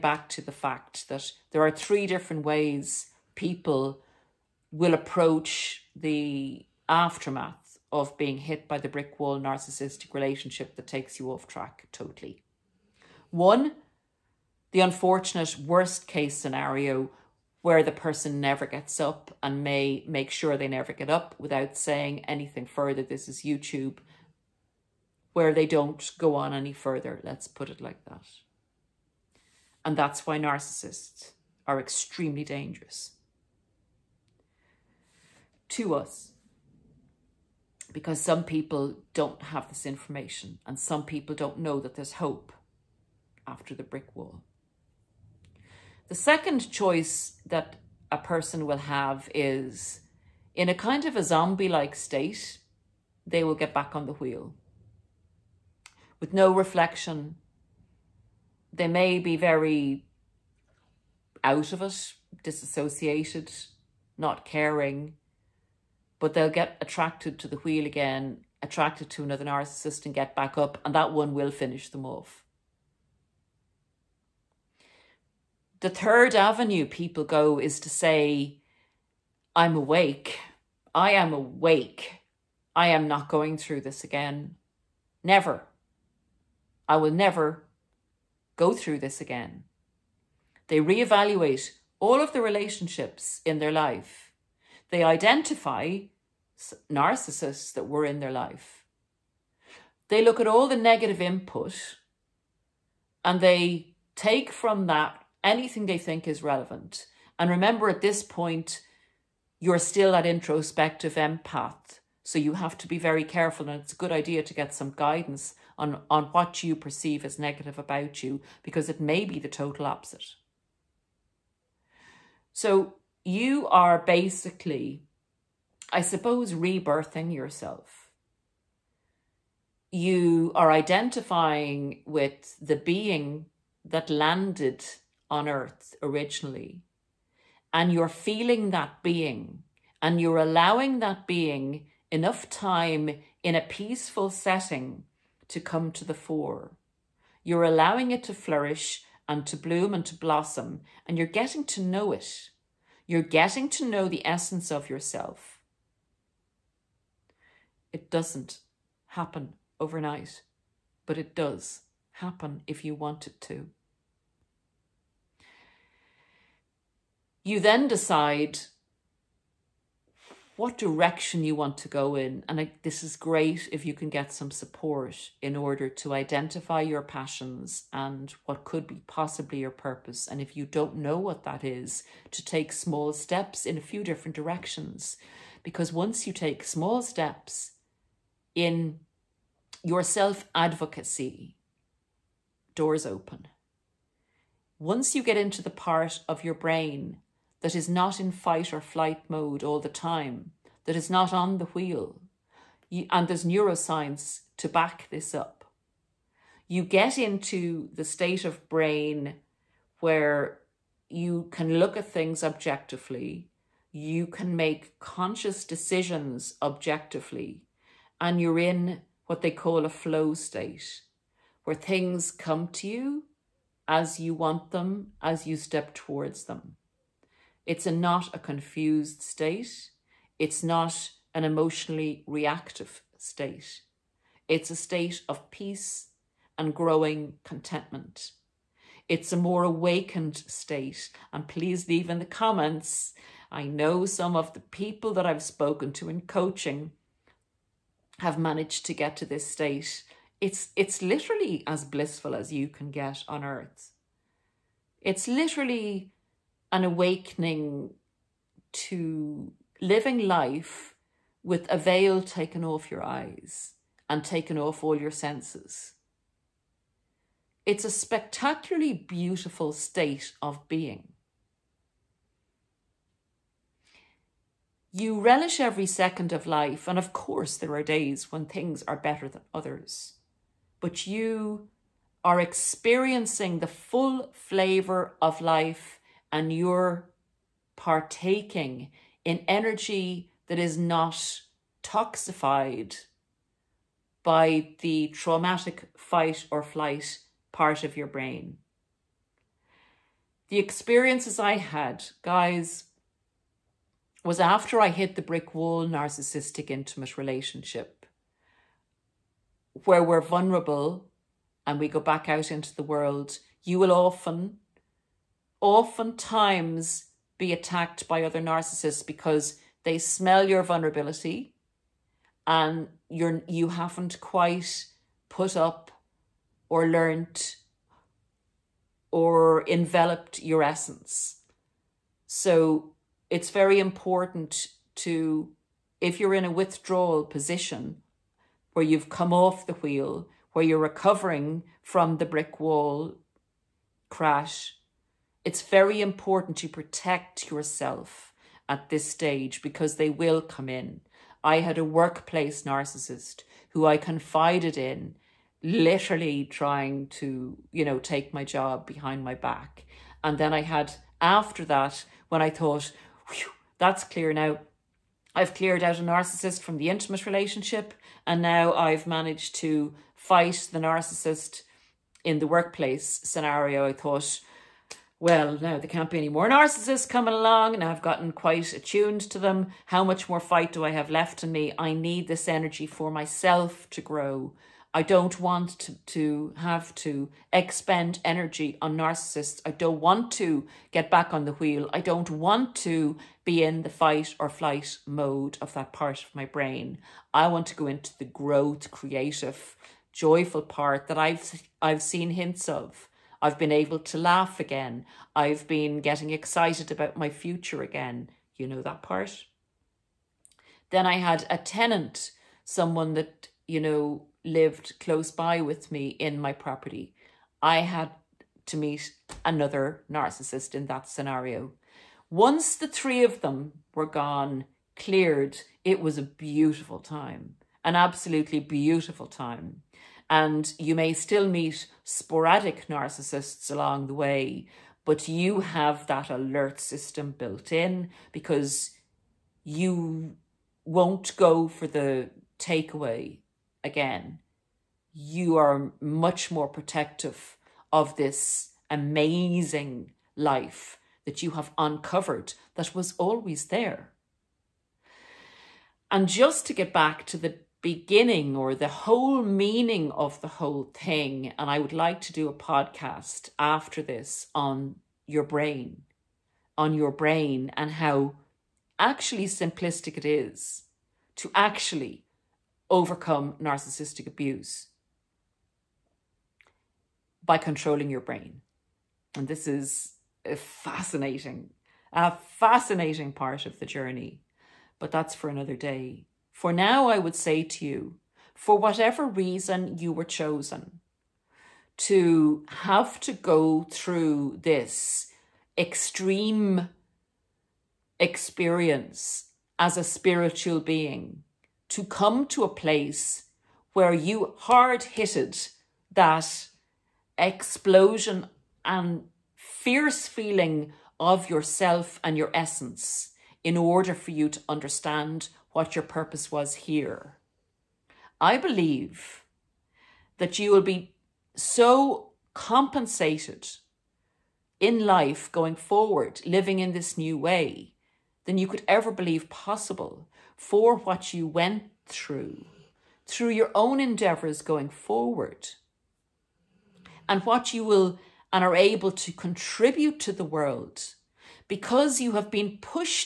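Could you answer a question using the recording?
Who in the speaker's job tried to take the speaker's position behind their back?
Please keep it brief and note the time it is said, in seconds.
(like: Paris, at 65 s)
workplace narcissist, at 351 s.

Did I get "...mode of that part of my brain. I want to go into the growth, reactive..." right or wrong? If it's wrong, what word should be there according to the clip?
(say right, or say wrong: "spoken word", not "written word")
wrong: "creative", not "reactive".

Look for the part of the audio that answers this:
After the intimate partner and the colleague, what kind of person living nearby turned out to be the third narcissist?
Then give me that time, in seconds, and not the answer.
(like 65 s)
411 s.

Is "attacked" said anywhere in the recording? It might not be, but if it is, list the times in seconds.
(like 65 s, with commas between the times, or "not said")
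317 s.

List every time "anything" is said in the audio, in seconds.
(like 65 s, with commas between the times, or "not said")
22 s, 105 s.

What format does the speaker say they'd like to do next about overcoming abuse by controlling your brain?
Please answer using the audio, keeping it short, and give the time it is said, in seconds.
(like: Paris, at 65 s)
podcast, at 462 s.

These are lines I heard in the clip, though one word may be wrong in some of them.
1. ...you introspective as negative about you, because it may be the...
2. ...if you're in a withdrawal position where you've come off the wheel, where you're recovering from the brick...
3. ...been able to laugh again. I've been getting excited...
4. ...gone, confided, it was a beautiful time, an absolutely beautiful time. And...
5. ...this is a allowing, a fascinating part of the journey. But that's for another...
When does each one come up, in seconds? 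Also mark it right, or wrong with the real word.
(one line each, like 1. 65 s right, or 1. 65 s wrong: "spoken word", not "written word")
1. 116 s wrong: "perceive", not "introspective"
2. 336 s right
3. 403 s right
4. 424 s wrong: "cleared", not "confided"
5. 479 s wrong: "fascinating", not "allowing".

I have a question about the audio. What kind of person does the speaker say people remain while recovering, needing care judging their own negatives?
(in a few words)
introspective empath.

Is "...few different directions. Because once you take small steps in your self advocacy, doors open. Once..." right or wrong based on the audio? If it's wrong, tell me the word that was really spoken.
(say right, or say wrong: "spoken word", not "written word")
right.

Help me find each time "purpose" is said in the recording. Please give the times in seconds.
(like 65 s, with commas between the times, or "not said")
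179 s, 516 s.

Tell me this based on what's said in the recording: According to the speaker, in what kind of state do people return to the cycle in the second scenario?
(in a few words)
zombie like state.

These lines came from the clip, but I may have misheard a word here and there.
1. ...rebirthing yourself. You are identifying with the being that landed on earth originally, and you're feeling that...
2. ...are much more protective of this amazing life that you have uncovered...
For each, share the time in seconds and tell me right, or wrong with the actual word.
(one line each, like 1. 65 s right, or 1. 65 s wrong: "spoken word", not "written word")
1. 126 s right
2. 445 s right.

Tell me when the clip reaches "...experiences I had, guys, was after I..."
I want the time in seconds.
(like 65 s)
300 s.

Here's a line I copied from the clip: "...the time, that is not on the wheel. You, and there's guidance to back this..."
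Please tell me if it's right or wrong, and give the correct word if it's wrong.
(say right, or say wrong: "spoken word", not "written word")
wrong: "neuroscience", not "guidance".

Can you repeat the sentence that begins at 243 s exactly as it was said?
I know some of the people that I've spoken to in coaching have managed to get to this state.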